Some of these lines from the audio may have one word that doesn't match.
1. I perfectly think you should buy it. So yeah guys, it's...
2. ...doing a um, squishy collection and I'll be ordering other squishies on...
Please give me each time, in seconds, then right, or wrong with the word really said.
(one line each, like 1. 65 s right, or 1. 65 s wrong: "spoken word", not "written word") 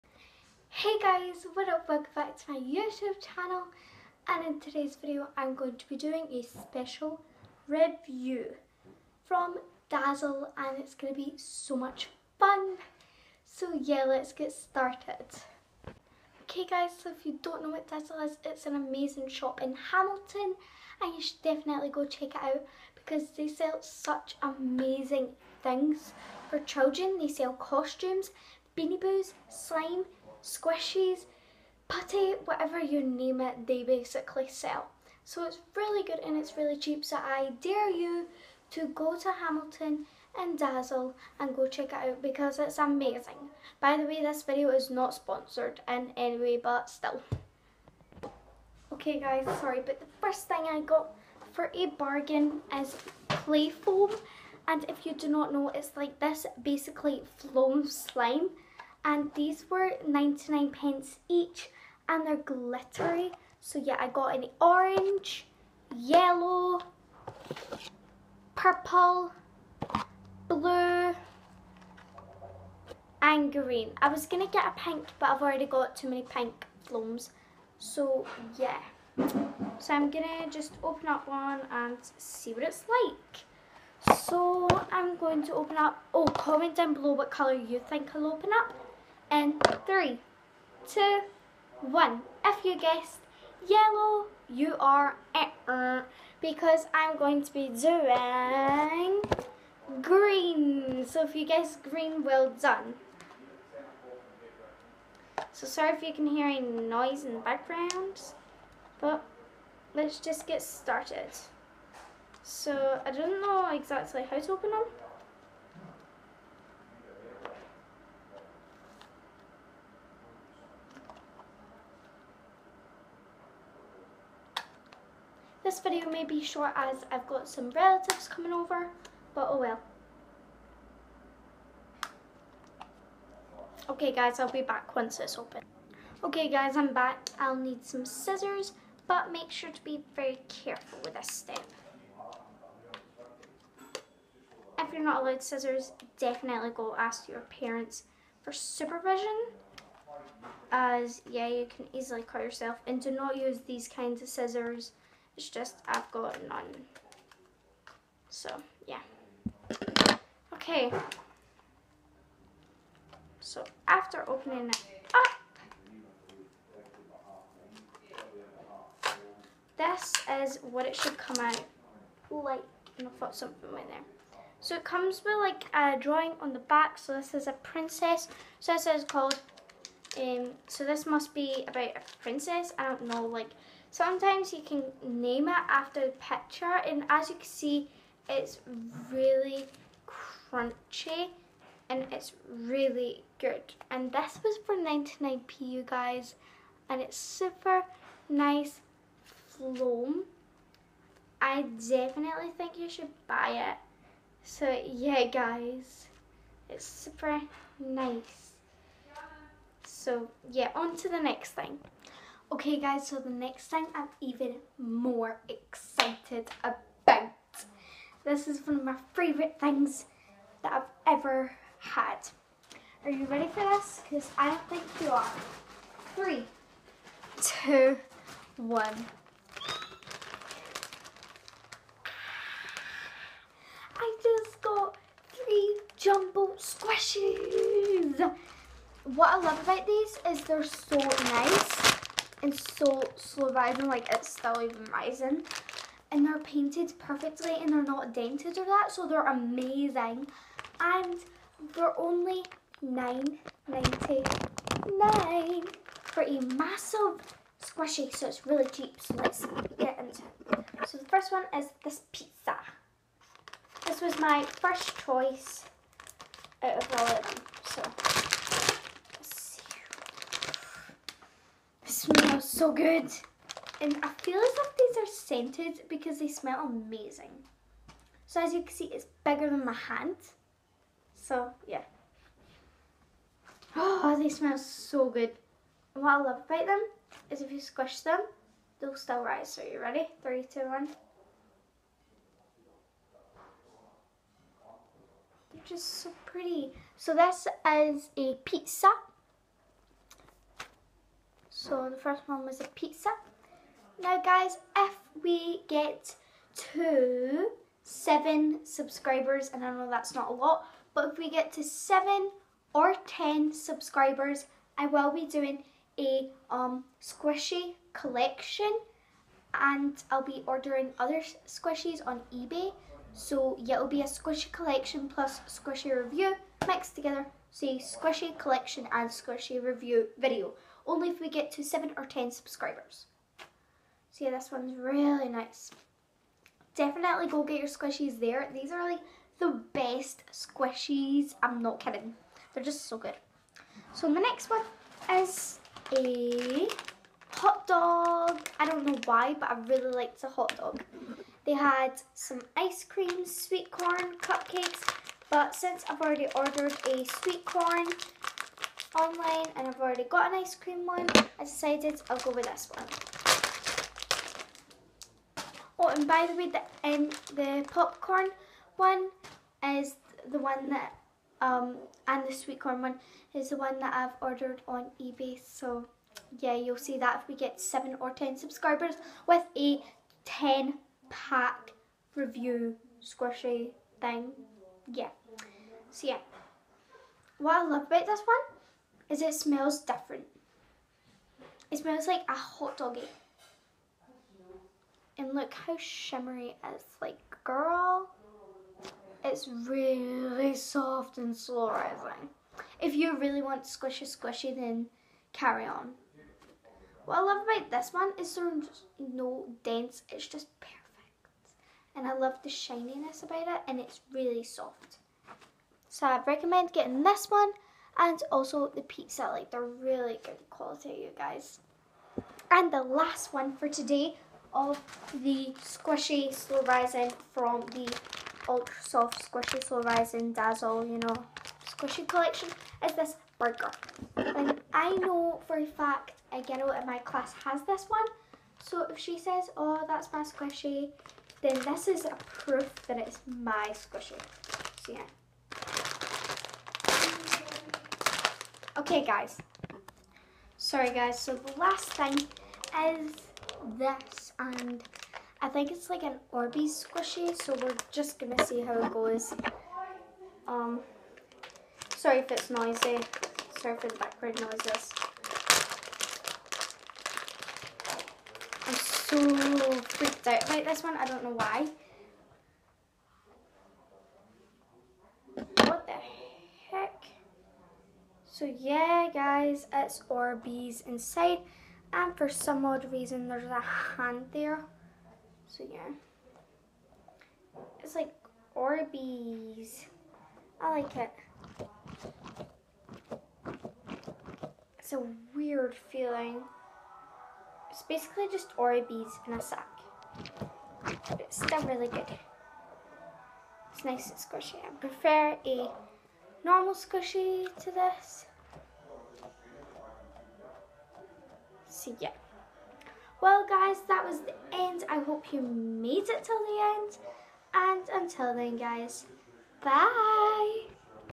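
1. 201 s wrong: "definitely", not "perfectly"
2. 315 s right.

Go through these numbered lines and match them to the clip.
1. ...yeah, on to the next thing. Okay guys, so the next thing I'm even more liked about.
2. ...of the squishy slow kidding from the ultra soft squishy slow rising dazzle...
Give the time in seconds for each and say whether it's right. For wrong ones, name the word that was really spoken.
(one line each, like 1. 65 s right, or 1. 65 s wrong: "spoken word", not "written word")
1. 210 s wrong: "excited", not "liked"
2. 424 s wrong: "rising", not "kidding".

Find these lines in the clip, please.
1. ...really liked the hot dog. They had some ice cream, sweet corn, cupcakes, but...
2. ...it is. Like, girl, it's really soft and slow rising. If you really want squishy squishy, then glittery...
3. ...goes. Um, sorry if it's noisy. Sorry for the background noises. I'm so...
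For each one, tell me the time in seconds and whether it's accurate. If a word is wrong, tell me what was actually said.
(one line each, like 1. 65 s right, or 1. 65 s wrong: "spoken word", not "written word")
1. 349 s right
2. 396 s wrong: "carry", not "glittery"
3. 458 s right.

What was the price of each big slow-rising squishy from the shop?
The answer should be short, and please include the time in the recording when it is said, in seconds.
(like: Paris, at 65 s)
9.99, at 252 s.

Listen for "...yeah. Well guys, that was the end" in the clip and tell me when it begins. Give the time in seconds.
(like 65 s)
511 s.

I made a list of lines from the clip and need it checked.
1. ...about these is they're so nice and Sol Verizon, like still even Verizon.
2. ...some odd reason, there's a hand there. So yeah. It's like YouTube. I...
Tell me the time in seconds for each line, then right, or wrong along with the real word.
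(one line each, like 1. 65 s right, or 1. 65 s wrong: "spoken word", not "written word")
1. 239 s wrong: "Slovavian", not "Verizon"
2. 482 s wrong: "Orbeez", not "YouTube".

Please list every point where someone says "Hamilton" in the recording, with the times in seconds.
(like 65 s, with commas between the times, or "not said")
19 s, 39 s.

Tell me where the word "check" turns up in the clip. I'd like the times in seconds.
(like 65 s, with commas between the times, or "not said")
22 s, 41 s.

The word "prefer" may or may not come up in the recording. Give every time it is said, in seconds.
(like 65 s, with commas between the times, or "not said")
504 s.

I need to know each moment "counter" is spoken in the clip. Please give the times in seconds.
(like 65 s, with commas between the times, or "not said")
not said.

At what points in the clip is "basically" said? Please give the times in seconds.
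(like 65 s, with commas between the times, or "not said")
33 s, 56 s, 497 s.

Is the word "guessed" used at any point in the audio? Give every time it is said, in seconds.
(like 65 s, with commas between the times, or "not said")
92 s, 101 s.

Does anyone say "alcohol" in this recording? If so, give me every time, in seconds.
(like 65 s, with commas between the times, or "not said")
not said.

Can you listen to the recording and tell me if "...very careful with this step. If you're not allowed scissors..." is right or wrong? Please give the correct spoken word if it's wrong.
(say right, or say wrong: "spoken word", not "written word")
right.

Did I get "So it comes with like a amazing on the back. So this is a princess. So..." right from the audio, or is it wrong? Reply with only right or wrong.
wrong.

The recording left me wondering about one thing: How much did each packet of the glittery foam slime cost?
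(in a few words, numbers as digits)
99 pence.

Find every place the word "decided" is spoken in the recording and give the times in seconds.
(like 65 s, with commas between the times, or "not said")
361 s.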